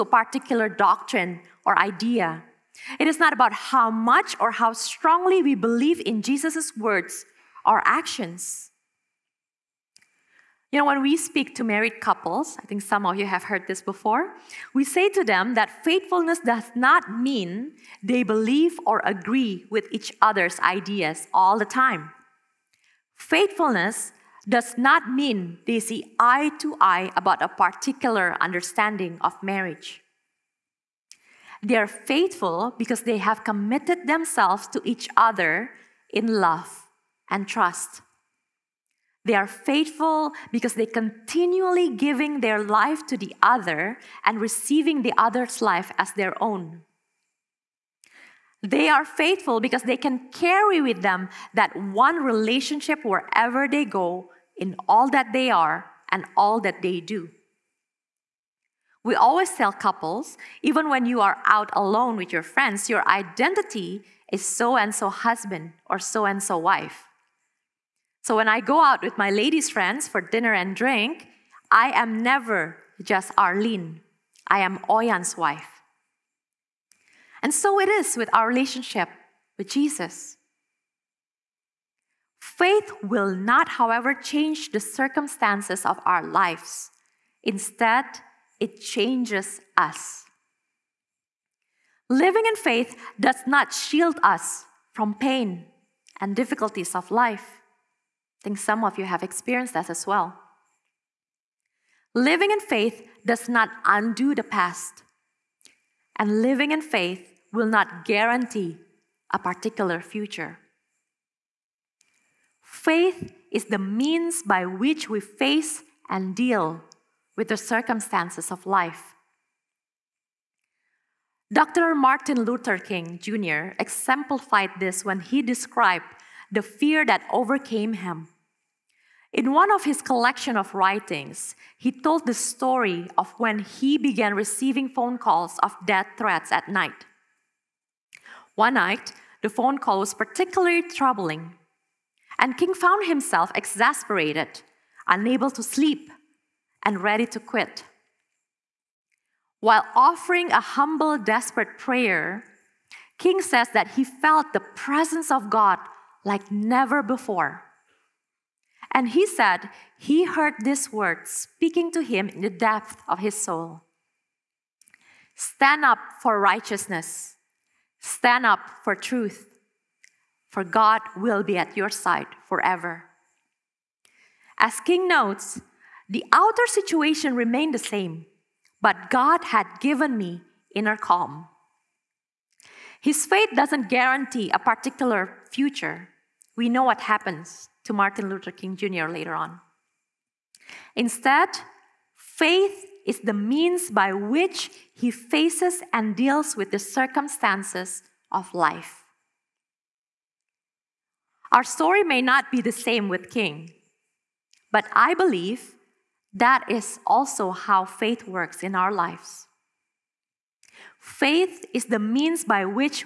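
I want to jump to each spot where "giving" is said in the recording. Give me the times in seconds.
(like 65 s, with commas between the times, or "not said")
41 s.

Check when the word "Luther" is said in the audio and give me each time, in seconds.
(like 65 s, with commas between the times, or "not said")
122 s, 188 s.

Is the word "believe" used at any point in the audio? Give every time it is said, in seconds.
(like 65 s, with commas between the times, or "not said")
5 s, 18 s, 205 s.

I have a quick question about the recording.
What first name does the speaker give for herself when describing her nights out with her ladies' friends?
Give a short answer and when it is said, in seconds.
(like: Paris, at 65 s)
Arlene, at 73 s.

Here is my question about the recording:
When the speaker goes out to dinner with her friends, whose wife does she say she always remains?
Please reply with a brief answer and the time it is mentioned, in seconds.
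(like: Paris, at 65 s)
Oyan's wife, at 74 s.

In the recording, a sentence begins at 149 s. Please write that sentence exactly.
While offering a humble, desperate prayer, King says that he felt the presence of God like never before.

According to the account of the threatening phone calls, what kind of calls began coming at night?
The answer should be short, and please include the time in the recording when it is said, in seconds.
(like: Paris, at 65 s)
Death threats, at 135 s.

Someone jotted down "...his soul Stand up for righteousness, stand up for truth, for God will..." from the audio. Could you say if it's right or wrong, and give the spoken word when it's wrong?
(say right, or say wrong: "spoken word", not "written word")
right.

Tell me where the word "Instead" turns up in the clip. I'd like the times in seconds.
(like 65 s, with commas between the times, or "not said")
87 s, 190 s.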